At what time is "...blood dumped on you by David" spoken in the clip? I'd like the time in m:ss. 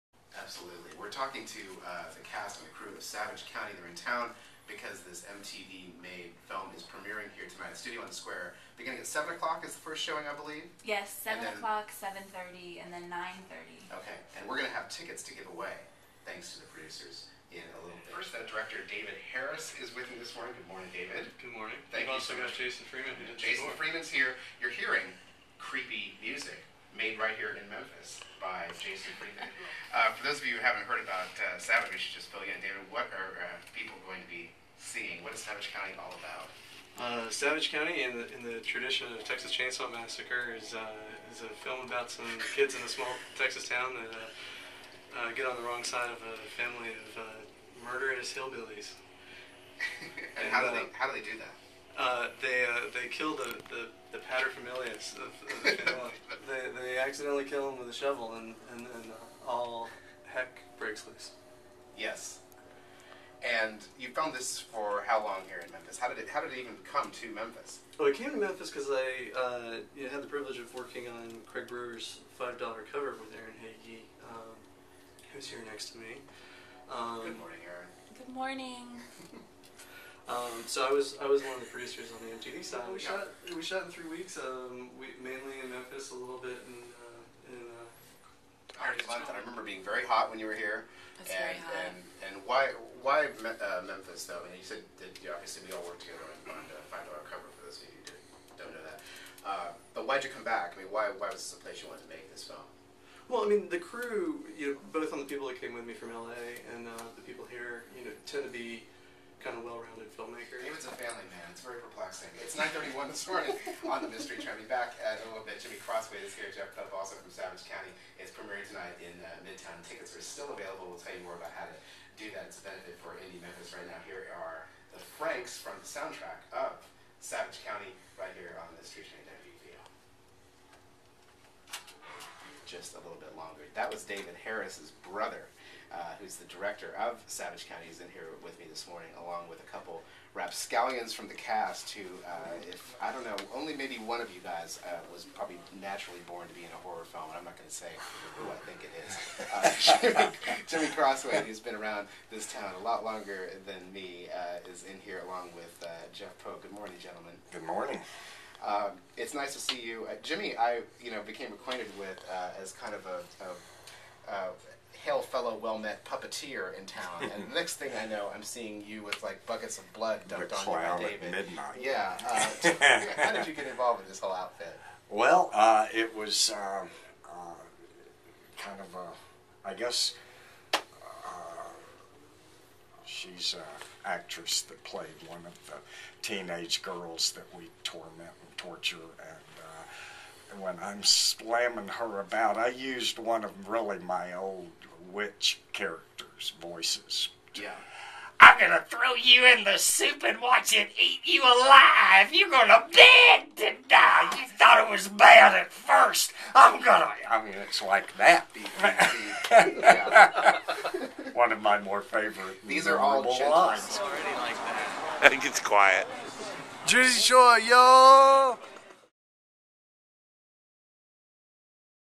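2:49.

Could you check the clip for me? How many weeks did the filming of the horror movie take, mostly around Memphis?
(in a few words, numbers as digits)
3.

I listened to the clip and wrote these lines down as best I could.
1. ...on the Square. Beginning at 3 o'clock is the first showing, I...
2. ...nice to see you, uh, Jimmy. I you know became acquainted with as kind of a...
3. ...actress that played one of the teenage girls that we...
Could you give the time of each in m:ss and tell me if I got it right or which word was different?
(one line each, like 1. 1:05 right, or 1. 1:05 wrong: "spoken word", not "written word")
1. 0:08 wrong: "7", not "3"
2. 2:39 right
3. 3:04 right.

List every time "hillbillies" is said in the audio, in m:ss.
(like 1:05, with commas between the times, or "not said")
0:48.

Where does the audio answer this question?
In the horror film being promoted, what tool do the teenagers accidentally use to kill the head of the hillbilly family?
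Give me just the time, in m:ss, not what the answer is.
0:57.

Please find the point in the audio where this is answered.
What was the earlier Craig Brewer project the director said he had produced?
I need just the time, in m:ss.
1:12.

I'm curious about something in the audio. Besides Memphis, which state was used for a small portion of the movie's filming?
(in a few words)
Arkansas.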